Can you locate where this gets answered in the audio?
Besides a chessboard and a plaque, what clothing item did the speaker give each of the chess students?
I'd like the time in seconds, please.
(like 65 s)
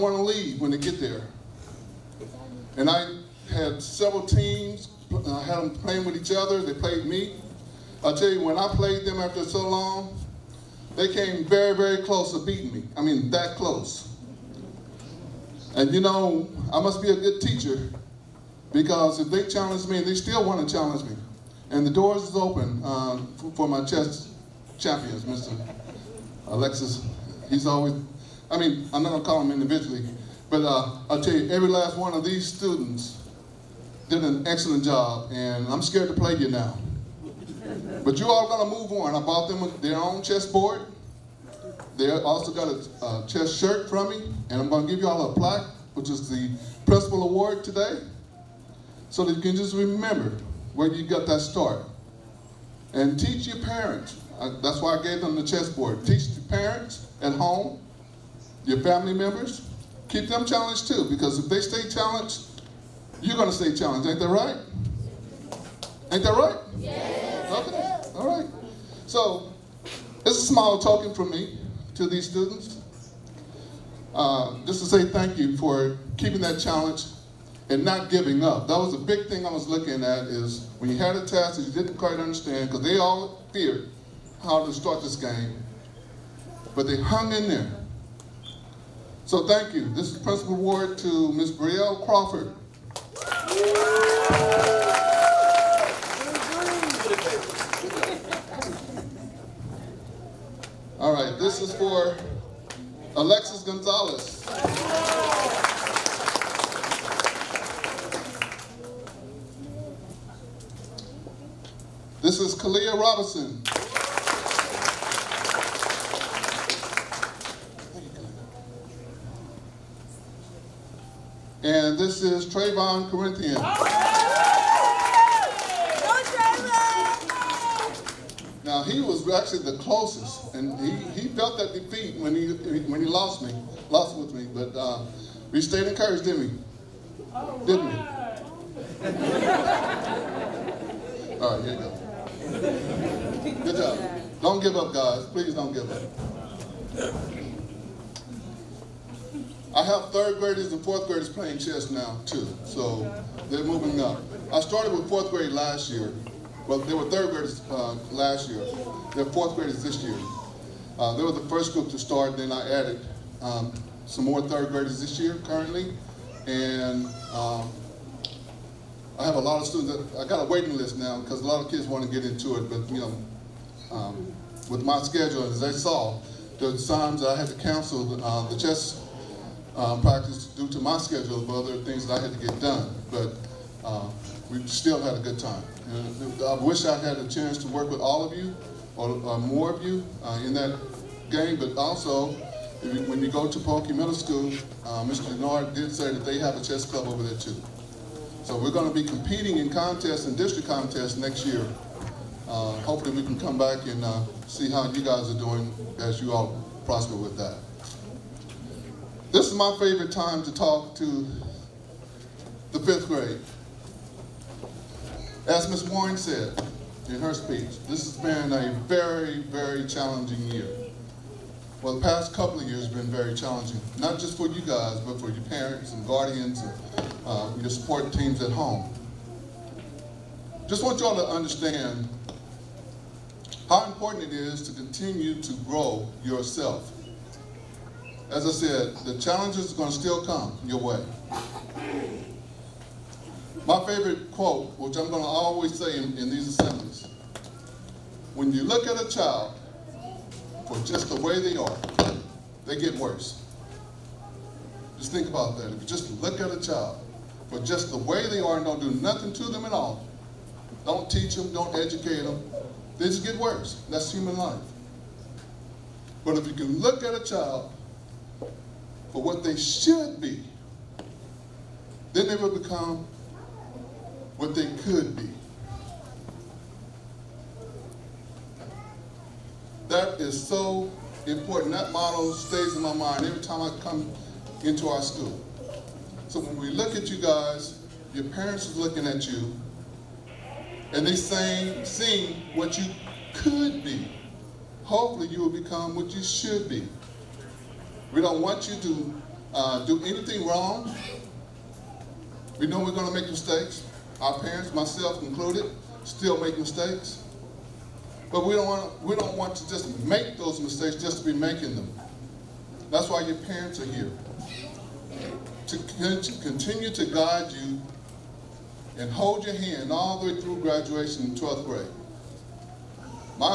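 43 s.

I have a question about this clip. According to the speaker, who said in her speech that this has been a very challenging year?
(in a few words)
Ms. Warren.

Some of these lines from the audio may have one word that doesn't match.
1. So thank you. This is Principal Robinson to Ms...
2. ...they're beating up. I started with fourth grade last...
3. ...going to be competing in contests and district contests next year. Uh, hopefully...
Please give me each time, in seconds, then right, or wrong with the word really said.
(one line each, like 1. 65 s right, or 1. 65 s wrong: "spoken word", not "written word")
1. 89 s wrong: "Award", not "Robinson"
2. 153 s wrong: "moving", not "beating"
3. 198 s right.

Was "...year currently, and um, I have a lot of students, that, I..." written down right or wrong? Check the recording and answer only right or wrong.
right.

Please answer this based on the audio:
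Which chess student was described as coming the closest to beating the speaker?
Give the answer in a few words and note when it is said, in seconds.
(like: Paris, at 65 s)
Trayvon Corinthians, at 122 s.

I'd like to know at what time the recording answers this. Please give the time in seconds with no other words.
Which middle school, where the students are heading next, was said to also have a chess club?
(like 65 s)
193 s.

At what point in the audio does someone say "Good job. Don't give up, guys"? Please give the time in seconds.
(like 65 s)
143 s.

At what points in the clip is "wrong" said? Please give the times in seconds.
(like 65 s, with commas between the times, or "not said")
300 s.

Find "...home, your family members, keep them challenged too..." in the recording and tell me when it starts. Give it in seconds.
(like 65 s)
57 s.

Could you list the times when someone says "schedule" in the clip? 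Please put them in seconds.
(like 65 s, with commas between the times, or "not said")
175 s, 180 s.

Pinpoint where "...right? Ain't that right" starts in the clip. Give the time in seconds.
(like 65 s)
64 s.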